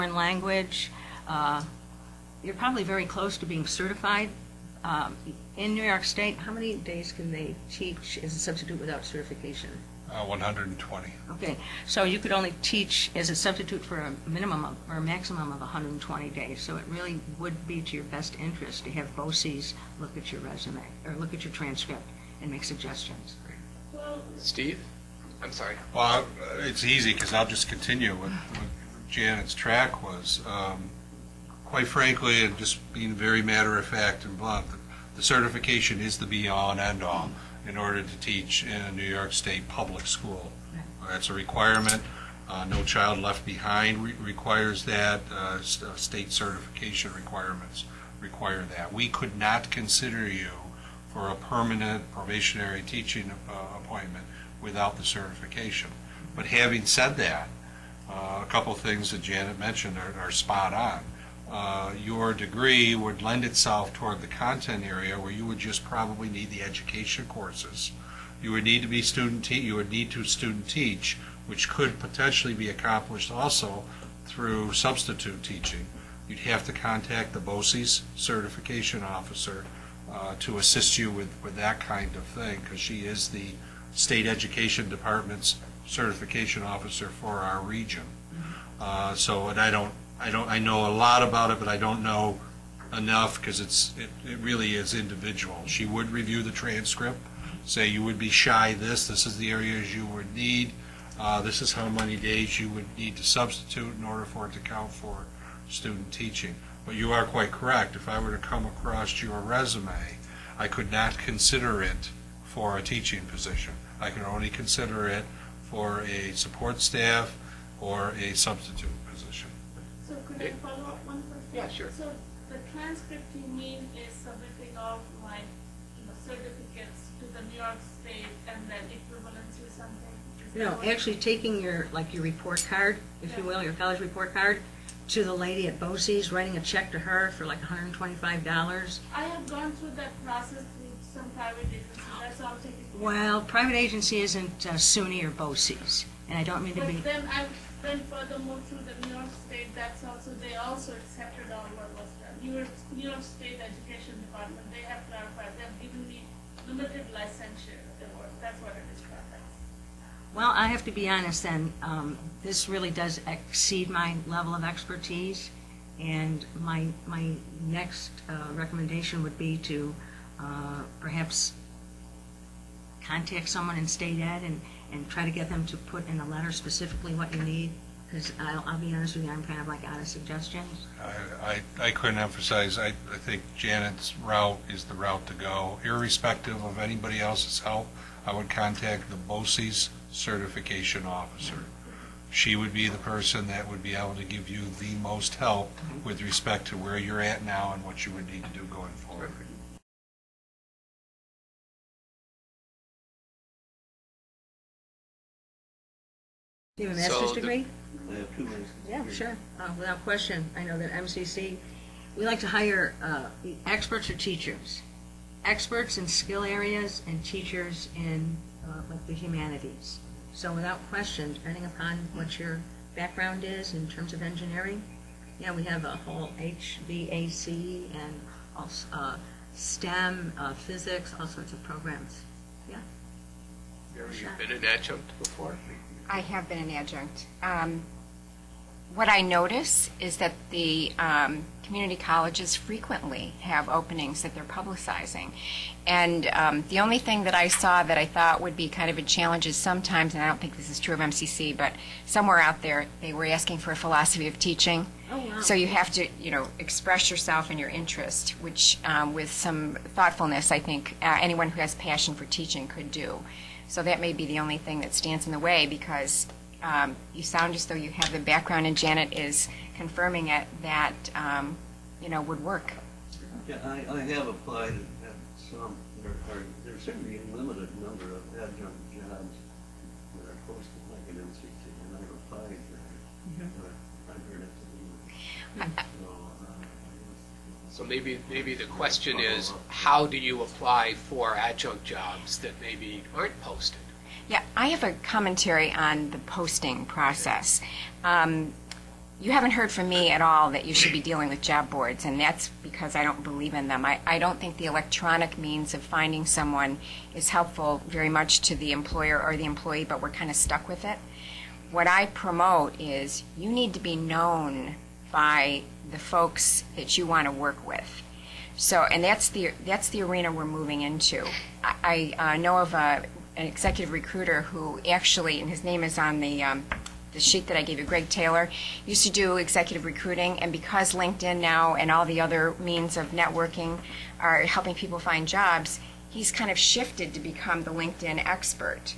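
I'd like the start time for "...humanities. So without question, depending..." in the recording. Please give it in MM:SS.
03:39.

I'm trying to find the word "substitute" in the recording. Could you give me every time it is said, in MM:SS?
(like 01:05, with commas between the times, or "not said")
00:08, 00:13, 01:14, 01:43, 01:58.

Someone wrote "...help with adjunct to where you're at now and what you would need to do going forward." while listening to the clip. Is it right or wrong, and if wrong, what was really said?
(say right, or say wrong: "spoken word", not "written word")
wrong: "respect", not "adjunct".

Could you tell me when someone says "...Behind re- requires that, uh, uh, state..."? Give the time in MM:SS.
00:43.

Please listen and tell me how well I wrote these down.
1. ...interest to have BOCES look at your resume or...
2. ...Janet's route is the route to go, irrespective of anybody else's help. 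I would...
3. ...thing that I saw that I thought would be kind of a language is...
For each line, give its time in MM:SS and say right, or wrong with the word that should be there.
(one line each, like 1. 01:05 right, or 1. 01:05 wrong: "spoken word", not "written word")
1. 00:18 right
2. 03:03 right
3. 04:06 wrong: "challenge", not "language".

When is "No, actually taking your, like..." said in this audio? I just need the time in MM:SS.
02:10.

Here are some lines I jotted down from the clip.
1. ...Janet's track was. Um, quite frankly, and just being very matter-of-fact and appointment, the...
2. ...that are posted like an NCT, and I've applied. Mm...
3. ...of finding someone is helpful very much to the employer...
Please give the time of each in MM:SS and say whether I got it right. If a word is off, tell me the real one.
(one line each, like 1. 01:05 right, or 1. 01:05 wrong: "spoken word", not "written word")
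1. 00:29 wrong: "blunt", not "appointment"
2. 04:40 right
3. 05:05 right.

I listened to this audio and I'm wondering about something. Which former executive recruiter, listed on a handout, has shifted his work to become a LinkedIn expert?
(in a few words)
Greg Taylor.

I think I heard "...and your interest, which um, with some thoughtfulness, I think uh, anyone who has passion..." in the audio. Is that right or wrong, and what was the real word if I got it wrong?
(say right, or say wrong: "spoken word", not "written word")
right.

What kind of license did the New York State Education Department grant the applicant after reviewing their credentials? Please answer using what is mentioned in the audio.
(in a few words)
limited licensure.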